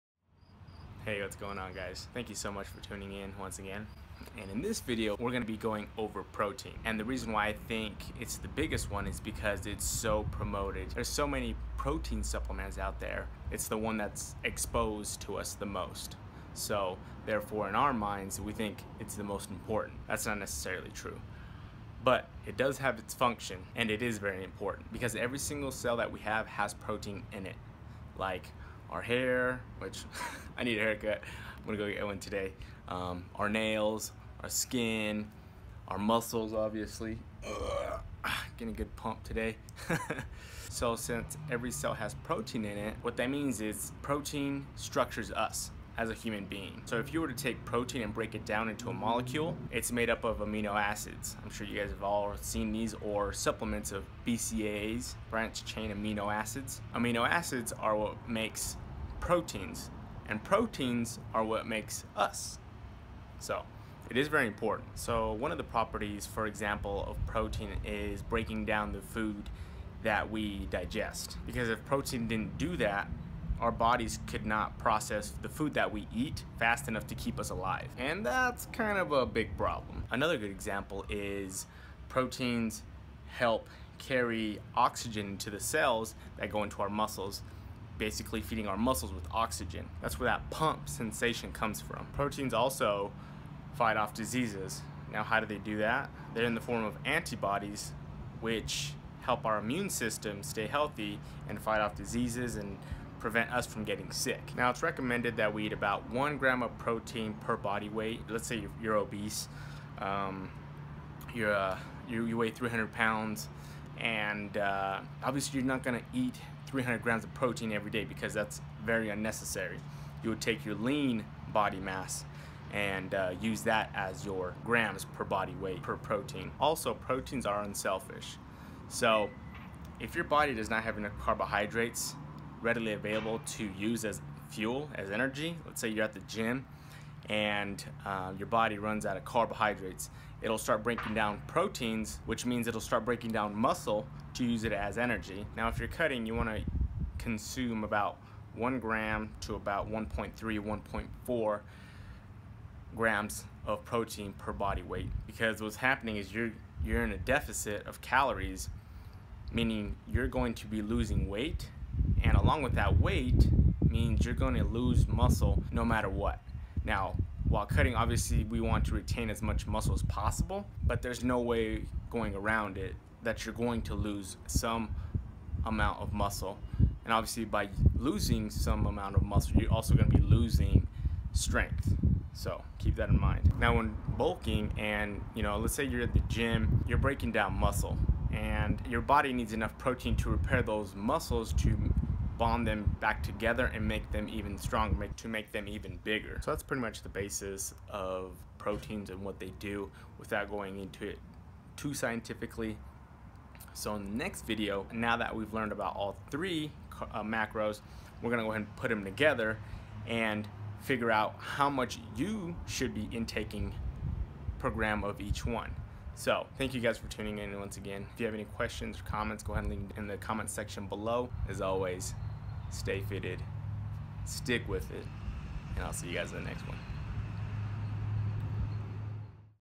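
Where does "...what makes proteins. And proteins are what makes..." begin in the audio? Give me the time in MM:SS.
00:57.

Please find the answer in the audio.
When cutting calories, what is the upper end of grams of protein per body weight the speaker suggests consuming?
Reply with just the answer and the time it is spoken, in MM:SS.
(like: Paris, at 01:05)
1.4 grams, at 02:30.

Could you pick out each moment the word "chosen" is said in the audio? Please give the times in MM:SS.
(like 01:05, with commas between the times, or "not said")
not said.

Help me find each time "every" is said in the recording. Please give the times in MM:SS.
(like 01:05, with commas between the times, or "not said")
00:25, 00:41, 01:57.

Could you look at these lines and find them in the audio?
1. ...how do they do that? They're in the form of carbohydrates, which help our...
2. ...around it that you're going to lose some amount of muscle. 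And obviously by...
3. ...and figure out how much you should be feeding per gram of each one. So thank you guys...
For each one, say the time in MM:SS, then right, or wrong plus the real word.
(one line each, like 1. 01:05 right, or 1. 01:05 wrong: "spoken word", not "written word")
1. 01:35 wrong: "antibodies", not "carbohydrates"
2. 02:52 right
3. 03:30 wrong: "intaking", not "feeding".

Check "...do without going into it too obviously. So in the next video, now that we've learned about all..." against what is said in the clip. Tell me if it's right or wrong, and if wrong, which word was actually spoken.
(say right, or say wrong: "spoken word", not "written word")
wrong: "scientifically", not "obviously".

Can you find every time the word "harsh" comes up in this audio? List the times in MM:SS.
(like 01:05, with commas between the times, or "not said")
not said.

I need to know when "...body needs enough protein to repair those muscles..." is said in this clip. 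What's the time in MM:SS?
03:09.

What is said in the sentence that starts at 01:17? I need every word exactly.
And that's kind of a big problem.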